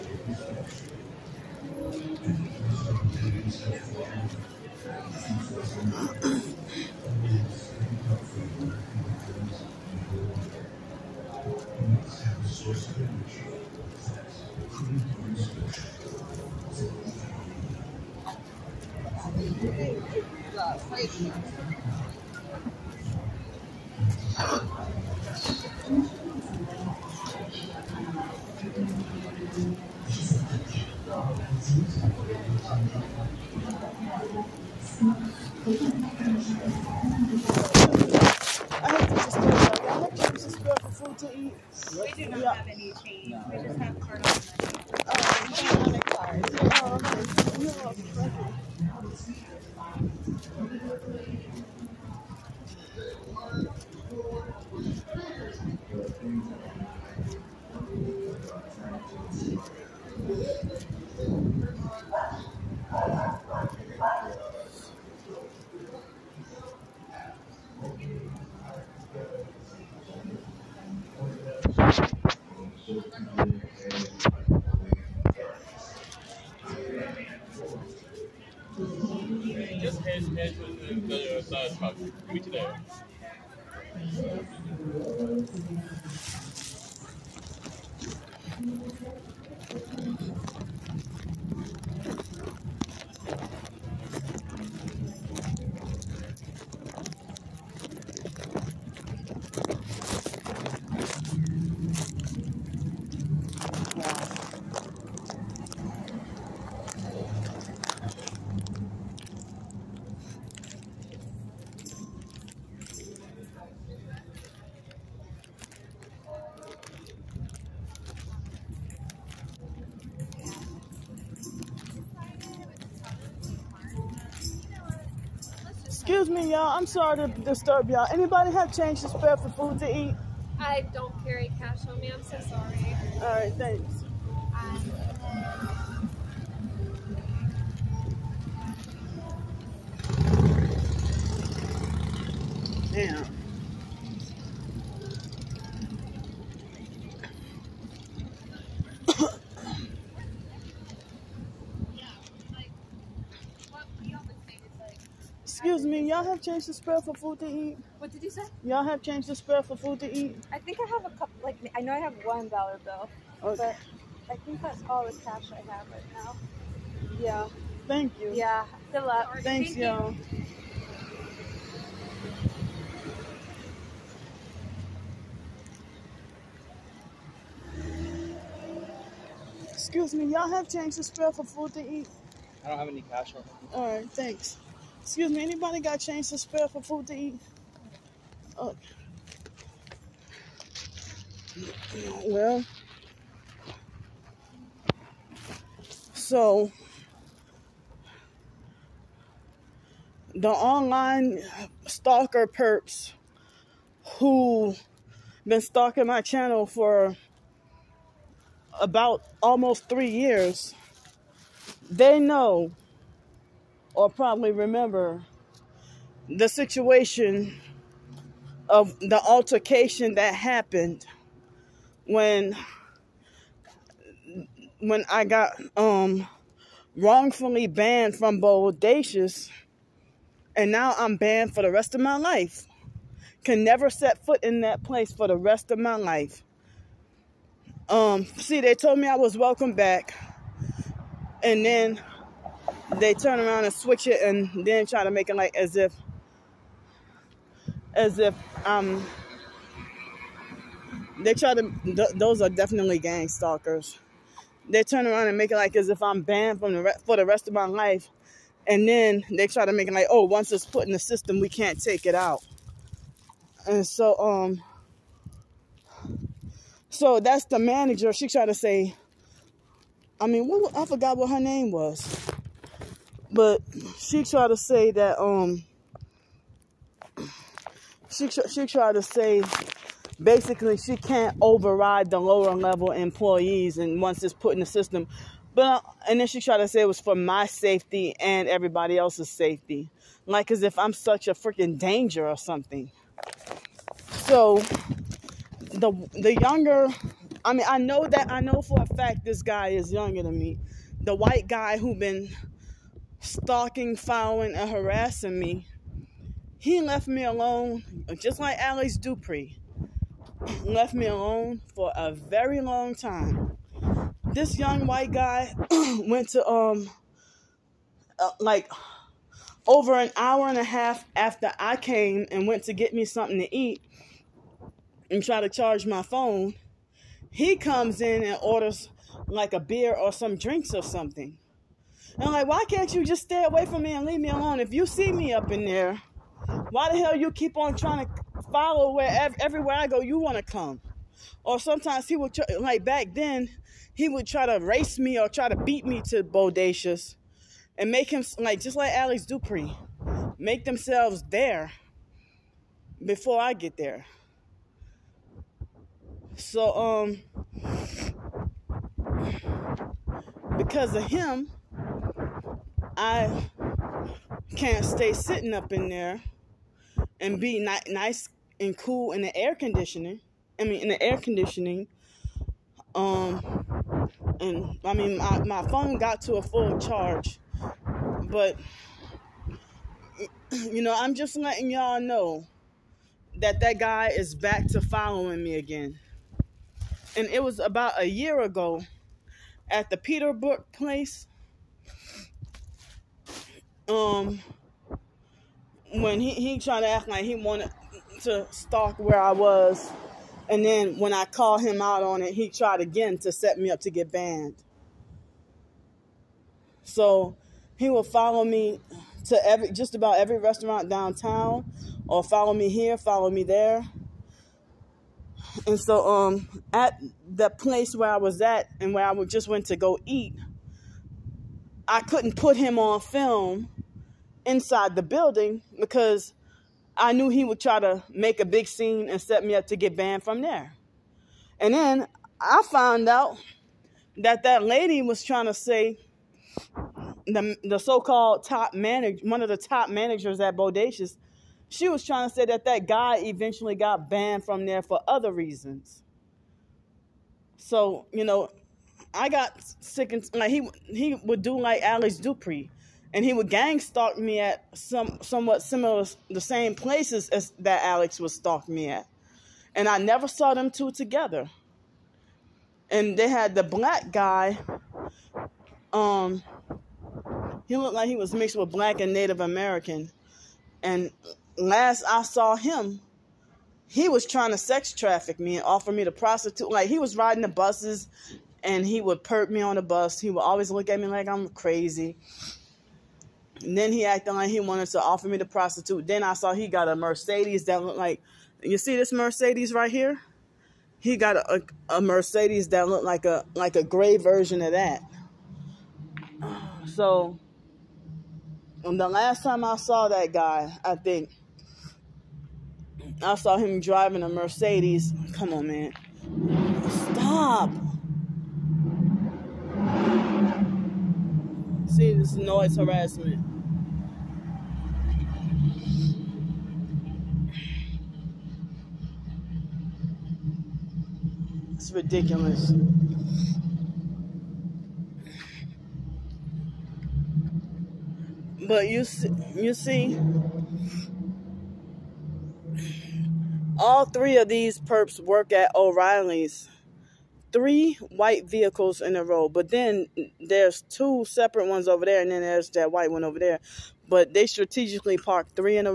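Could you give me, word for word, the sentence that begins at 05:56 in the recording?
So um because of him, I can't stay sitting up in there and be ni- nice and cool in the air conditioning.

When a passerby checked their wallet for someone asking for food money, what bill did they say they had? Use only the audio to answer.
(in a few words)
1 dollar.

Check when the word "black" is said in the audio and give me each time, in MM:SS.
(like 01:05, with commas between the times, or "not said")
07:43, 07:48.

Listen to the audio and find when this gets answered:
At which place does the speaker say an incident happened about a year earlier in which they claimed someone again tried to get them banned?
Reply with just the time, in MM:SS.
06:29.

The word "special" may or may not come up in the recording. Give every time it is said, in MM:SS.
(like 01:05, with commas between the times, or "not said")
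not said.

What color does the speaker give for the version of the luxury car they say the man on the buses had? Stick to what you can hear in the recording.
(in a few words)
gray.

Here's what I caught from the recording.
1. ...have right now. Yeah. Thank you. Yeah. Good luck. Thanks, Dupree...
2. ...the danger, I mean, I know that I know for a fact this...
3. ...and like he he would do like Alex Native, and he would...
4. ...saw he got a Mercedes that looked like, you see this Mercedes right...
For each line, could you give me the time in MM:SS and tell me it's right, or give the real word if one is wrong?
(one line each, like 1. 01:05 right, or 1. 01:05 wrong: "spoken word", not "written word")
1. 02:45 wrong: "Thank", not "Dupree"
2. 04:56 wrong: "younger", not "danger"
3. 07:30 wrong: "Dupree", not "Native"
4. 08:06 right.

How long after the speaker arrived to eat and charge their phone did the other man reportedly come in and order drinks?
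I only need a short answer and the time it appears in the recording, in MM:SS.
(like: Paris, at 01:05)
over an hour and a half, at 05:19.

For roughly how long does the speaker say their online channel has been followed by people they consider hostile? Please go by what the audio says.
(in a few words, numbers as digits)
almost 3 years.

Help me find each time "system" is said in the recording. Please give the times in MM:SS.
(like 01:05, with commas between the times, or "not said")
04:20, 04:44.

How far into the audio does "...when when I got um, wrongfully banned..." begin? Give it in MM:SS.
03:42.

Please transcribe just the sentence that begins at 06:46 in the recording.
So he will follow me to every just about every restaurant downtown, or follow me here, follow me there.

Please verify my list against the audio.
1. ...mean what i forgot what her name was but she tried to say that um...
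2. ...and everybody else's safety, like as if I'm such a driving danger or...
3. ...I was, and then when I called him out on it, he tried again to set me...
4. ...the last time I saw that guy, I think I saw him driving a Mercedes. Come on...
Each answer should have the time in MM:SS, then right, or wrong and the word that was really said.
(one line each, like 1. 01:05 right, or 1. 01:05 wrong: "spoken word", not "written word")
1. 04:30 right
2. 04:48 wrong: "freaking", not "driving"
3. 06:39 right
4. 08:18 right.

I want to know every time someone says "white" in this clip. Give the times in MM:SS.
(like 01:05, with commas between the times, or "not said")
05:01, 05:14, 08:58, 09:02.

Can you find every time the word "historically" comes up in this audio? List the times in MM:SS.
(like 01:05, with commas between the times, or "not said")
not said.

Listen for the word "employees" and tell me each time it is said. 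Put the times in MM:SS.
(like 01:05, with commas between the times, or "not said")
04:42.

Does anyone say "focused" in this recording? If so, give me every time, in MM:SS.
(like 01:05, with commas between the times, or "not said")
not said.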